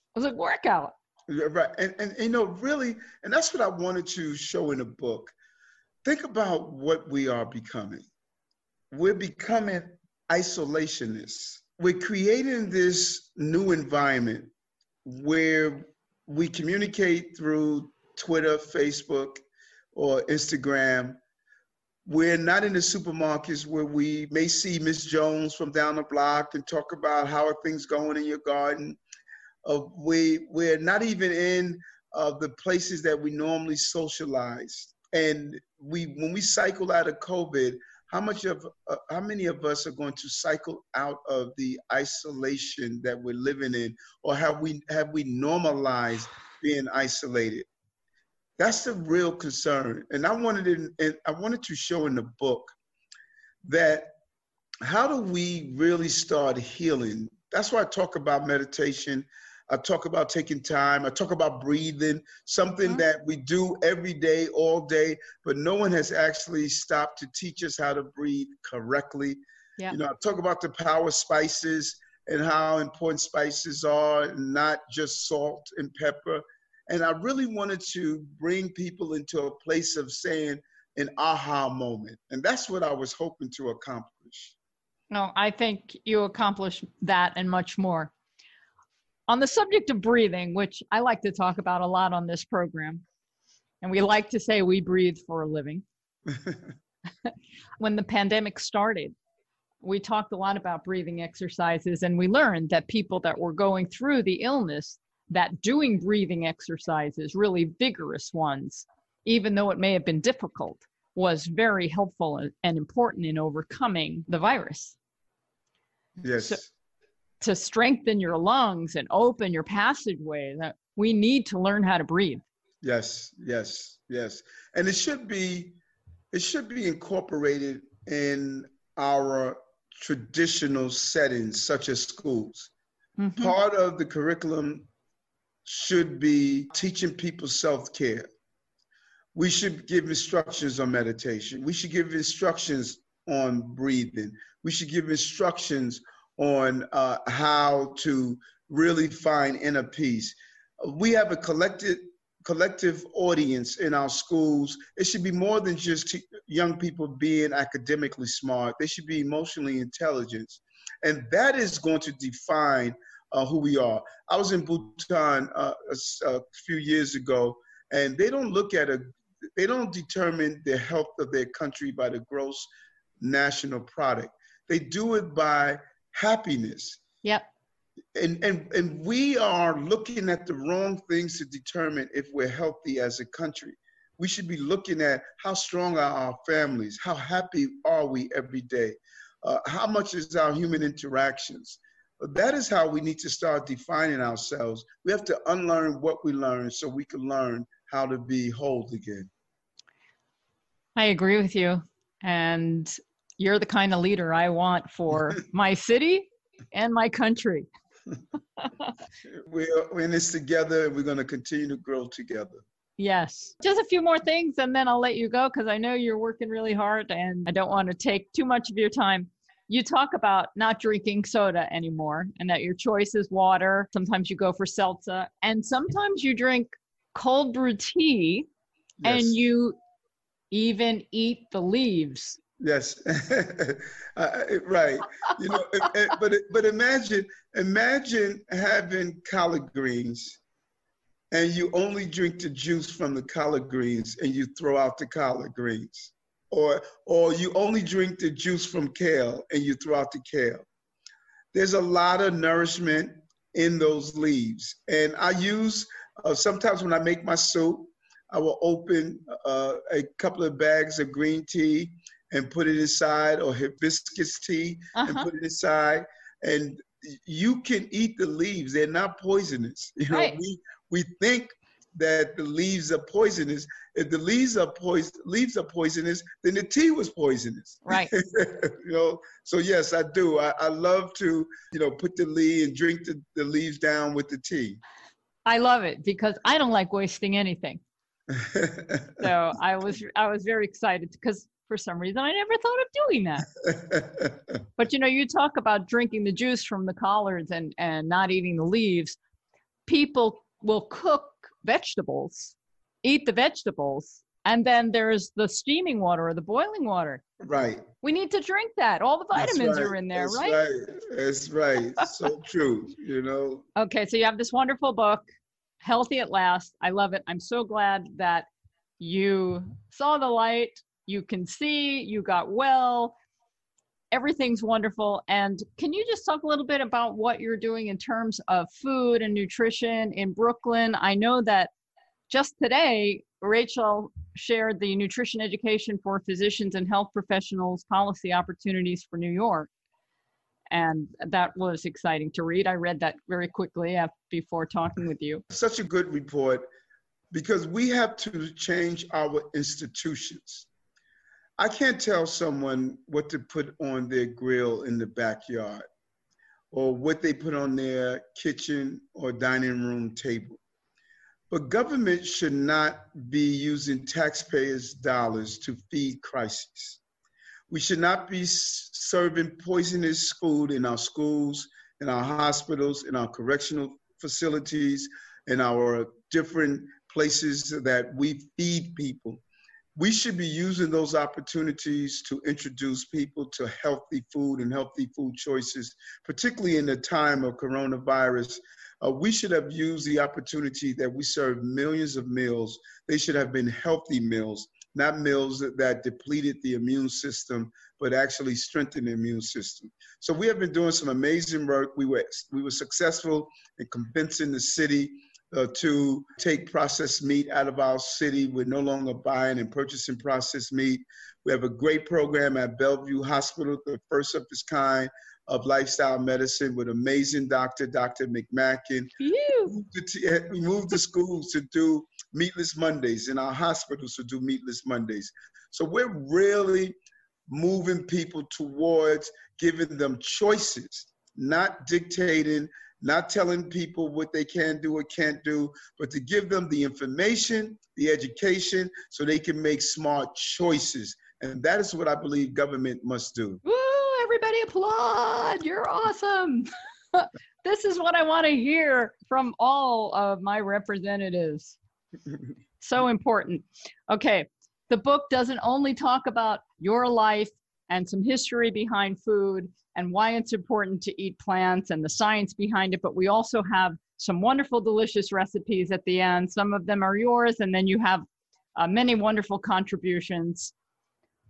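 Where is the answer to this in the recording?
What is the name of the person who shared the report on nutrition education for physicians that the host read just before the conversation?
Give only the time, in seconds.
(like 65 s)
333 s.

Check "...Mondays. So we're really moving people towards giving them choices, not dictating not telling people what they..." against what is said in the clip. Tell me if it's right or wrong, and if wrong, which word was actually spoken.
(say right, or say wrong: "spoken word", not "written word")
right.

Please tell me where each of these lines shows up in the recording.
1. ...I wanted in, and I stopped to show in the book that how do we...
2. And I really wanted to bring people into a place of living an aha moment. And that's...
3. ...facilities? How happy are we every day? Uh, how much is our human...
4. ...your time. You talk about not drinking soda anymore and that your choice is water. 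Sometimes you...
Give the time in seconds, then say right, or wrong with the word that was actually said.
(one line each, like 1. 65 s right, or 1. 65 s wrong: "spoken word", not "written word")
1. 50 s wrong: "wanted", not "stopped"
2. 76 s wrong: "saying", not "living"
3. 186 s wrong: "families", not "facilities"
4. 218 s right.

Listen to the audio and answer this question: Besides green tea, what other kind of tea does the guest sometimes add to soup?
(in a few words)
Hibiscus tea.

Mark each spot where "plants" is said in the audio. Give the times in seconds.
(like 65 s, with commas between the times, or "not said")
461 s.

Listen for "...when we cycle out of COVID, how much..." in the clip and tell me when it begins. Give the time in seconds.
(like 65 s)
36 s.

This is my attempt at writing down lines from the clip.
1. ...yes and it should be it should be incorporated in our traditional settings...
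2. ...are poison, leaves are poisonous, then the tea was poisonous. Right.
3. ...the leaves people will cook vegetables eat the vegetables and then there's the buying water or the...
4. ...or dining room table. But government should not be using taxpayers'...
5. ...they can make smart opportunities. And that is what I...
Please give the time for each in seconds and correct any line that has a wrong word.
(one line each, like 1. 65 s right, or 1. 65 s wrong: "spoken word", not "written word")
1. 124 s right
2. 274 s right
3. 298 s wrong: "steaming", not "buying"
4. 359 s right
5. 439 s wrong: "choices", not "opportunities".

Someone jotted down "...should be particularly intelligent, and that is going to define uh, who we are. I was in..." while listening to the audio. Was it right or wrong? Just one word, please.
wrong.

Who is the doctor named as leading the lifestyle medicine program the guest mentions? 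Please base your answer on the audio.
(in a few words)
Dr. McMacken.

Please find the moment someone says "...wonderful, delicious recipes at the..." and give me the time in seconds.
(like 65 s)
464 s.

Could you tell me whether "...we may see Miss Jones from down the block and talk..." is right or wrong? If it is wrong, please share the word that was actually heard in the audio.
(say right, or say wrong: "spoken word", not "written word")
right.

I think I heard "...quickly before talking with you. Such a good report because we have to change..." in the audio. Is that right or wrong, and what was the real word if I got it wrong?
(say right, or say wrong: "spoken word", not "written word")
right.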